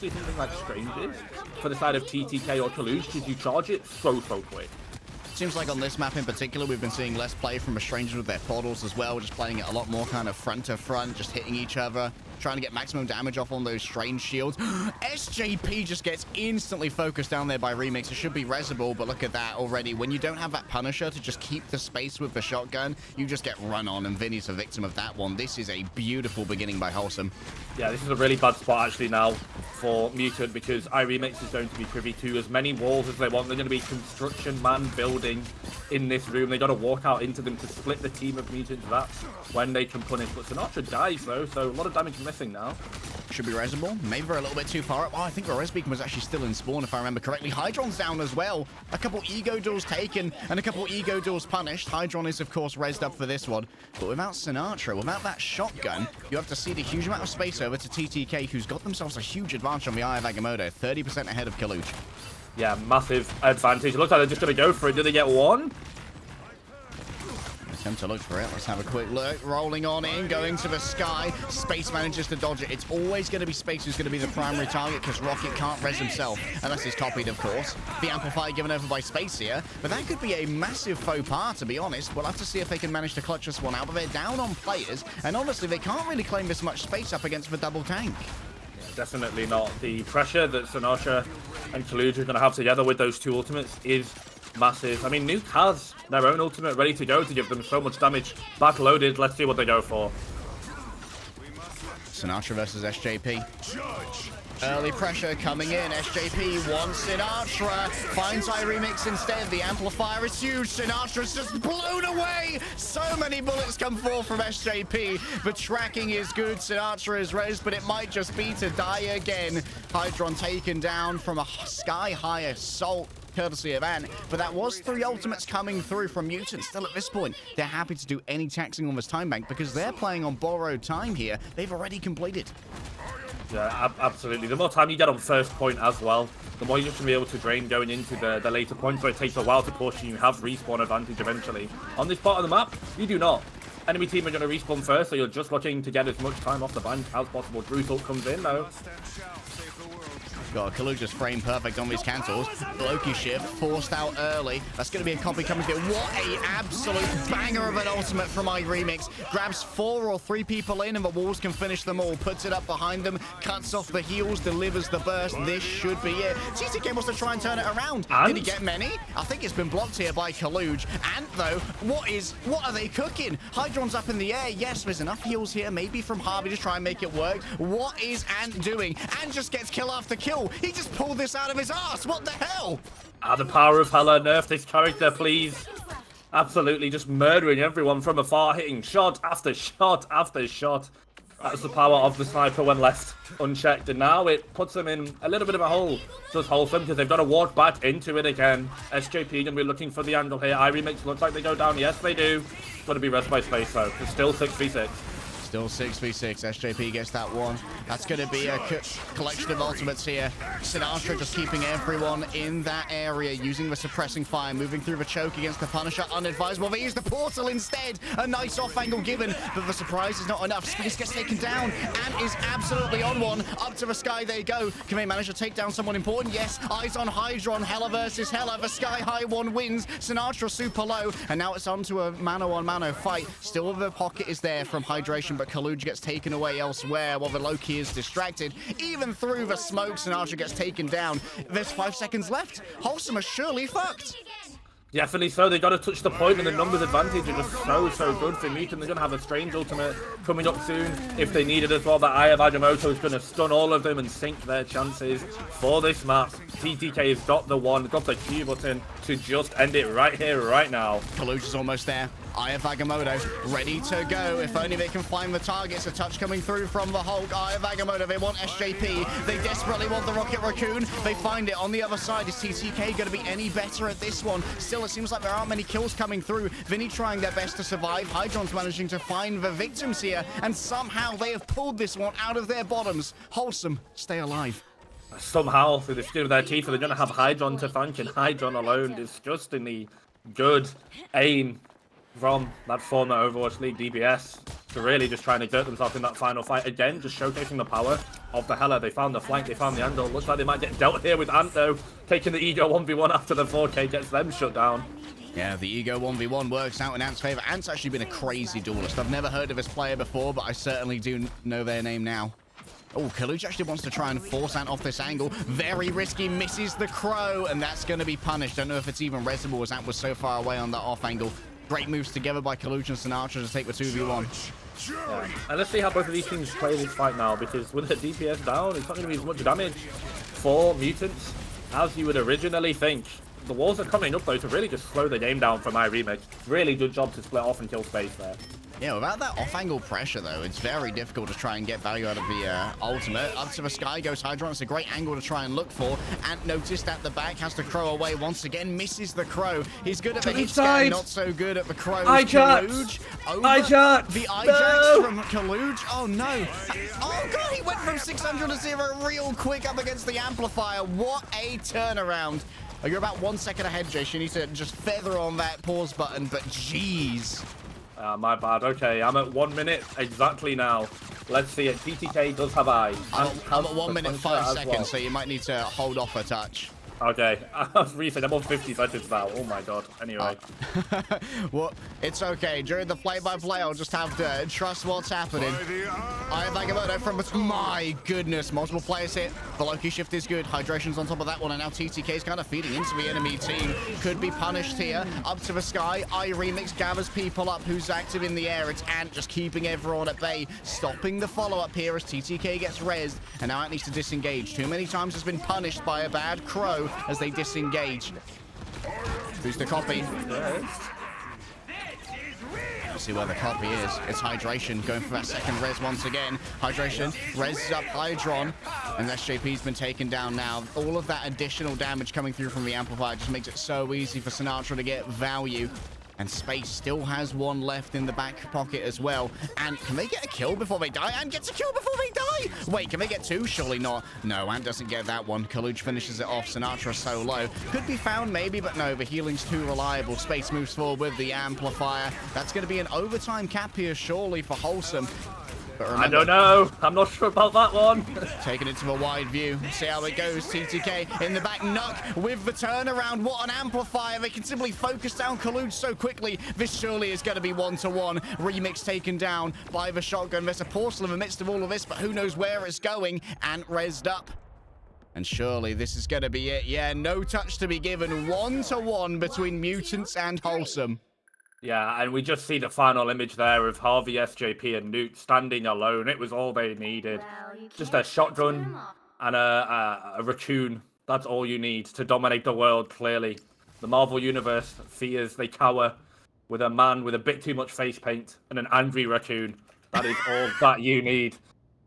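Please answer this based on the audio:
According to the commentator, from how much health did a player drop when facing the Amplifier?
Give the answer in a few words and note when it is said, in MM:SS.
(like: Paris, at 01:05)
600, at 05:57.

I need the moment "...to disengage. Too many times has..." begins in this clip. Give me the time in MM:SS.
06:43.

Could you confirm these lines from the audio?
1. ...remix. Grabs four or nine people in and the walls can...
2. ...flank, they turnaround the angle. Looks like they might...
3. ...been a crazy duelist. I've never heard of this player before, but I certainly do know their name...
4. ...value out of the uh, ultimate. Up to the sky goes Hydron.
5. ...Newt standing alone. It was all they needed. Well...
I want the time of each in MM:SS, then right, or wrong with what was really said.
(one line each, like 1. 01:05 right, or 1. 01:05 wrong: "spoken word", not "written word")
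1. 02:38 wrong: "three", not "nine"
2. 04:59 wrong: "found", not "turnaround"
3. 05:07 right
4. 05:41 right
5. 07:54 right.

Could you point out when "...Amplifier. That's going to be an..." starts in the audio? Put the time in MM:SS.
07:21.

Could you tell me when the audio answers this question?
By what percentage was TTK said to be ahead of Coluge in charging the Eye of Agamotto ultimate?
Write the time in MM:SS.
01:00.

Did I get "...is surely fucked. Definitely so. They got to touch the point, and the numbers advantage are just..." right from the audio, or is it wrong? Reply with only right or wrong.
right.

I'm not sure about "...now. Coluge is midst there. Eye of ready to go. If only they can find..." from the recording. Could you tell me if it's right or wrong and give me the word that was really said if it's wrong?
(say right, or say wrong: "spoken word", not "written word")
wrong: "almost", not "midst".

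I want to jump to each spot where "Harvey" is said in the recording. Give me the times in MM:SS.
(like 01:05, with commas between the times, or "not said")
02:56, 07:53.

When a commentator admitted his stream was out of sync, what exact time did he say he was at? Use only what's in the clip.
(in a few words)
1 minute.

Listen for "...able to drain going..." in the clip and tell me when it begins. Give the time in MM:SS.
02:17.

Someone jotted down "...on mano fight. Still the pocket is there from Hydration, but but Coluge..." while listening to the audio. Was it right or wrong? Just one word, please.
right.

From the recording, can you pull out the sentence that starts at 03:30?
Sinatraa just keeping everyone in that area, using the suppressing fire, moving through the choke against the Punisher.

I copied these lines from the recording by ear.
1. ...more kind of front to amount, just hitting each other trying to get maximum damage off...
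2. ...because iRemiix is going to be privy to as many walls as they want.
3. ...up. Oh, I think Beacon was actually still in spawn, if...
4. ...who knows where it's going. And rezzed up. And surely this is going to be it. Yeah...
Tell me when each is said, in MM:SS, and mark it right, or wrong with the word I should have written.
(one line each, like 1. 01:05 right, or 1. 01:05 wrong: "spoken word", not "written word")
1. 00:09 wrong: "front", not "amount"
2. 00:30 right
3. 00:45 right
4. 07:41 right.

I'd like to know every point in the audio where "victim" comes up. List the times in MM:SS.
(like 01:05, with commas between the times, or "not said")
00:24, 04:39.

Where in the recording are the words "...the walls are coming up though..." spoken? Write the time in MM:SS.
05:33.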